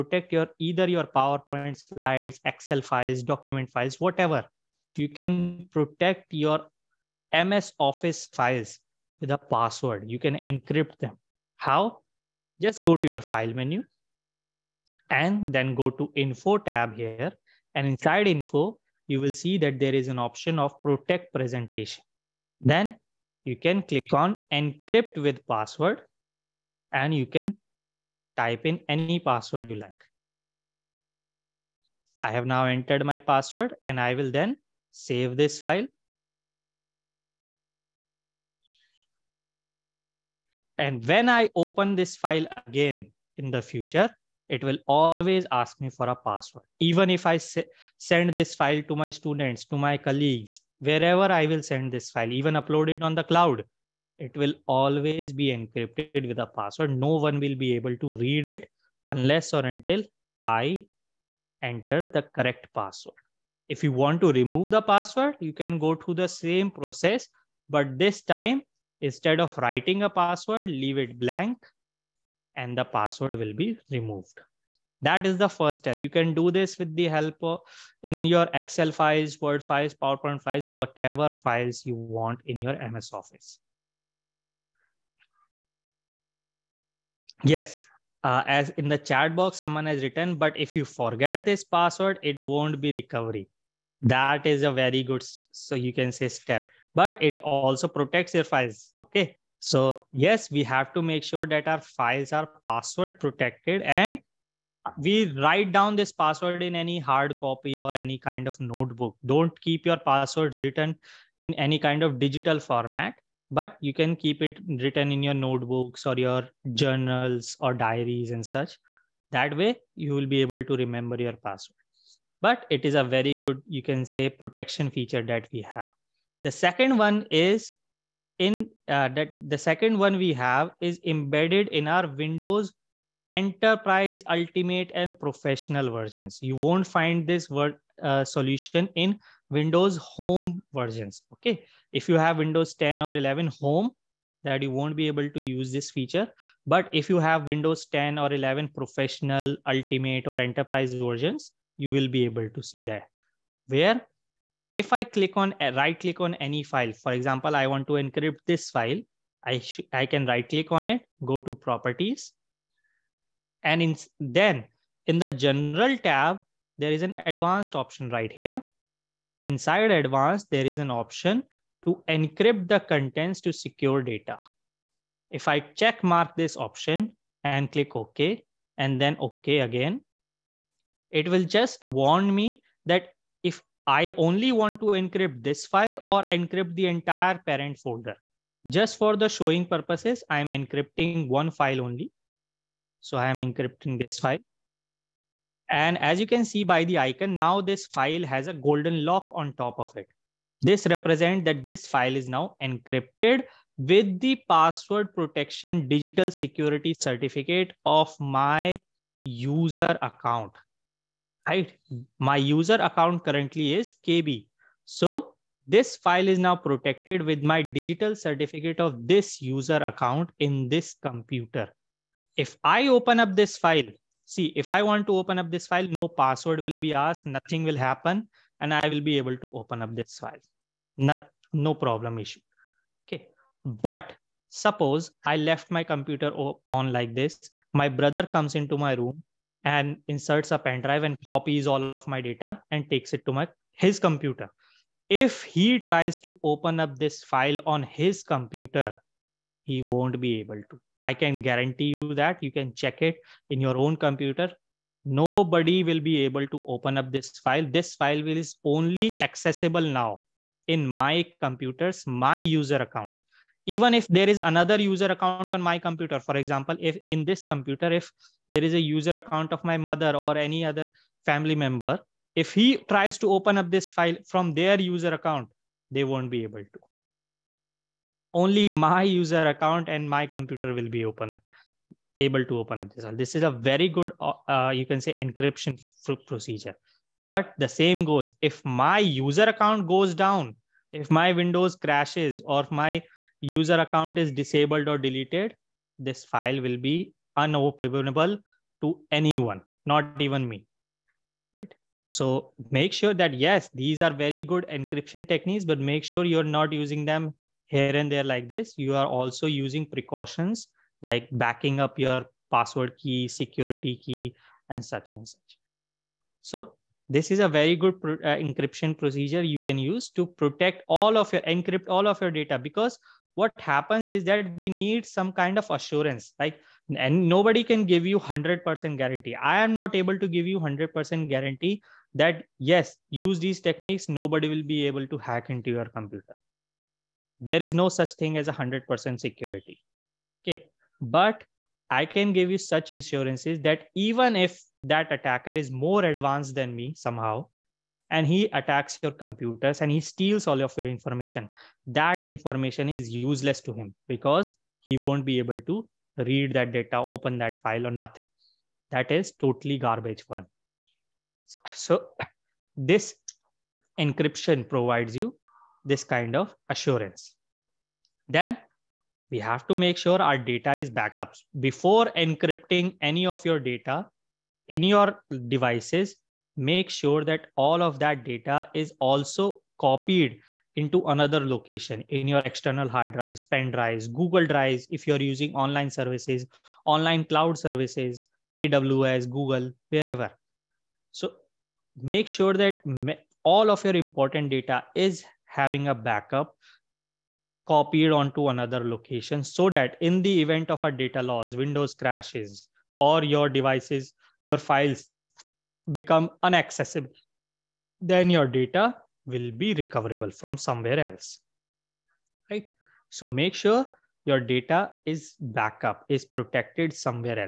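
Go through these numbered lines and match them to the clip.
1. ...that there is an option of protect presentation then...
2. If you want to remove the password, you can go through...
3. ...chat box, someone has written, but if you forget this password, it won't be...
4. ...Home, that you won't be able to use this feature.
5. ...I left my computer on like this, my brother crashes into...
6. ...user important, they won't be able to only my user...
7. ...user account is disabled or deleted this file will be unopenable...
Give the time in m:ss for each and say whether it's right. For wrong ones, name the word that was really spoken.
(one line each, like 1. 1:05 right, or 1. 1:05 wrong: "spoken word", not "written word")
1. 0:19 right
2. 1:03 right
3. 1:28 right
4. 2:23 right
5. 3:55 wrong: "comes", not "crashes"
6. 4:34 wrong: "account", not "important"
7. 4:53 right.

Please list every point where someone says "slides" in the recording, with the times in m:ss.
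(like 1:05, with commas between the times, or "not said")
0:01.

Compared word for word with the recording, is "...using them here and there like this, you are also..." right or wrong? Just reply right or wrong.
right.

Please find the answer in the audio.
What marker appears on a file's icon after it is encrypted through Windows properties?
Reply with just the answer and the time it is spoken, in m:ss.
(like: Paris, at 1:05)
Golden lock, at 3:18.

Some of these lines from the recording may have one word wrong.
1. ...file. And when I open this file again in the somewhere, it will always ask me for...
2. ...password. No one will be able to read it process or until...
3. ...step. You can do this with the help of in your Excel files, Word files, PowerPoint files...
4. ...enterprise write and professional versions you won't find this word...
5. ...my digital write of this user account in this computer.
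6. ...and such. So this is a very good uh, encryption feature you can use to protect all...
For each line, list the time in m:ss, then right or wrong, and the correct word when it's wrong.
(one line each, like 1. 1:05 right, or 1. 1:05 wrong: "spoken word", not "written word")
1. 0:35 wrong: "future", not "somewhere"
2. 0:56 wrong: "unless", not "process"
3. 1:15 right
4. 2:13 wrong: "ultimate", not "write"
5. 3:37 wrong: "certificate", not "write"
6. 5:15 wrong: "procedure", not "feature".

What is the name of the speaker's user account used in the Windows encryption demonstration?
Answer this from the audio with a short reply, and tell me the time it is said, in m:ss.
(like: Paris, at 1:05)
KB, at 3:34.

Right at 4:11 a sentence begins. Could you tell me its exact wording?
I can guarantee you that you can check it in your own computer.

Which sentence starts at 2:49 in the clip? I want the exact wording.
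Inside advanced, there is an option to encrypt the contents to secure data.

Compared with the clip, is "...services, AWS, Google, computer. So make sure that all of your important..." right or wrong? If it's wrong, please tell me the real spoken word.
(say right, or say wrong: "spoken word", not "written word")
wrong: "wherever", not "computer".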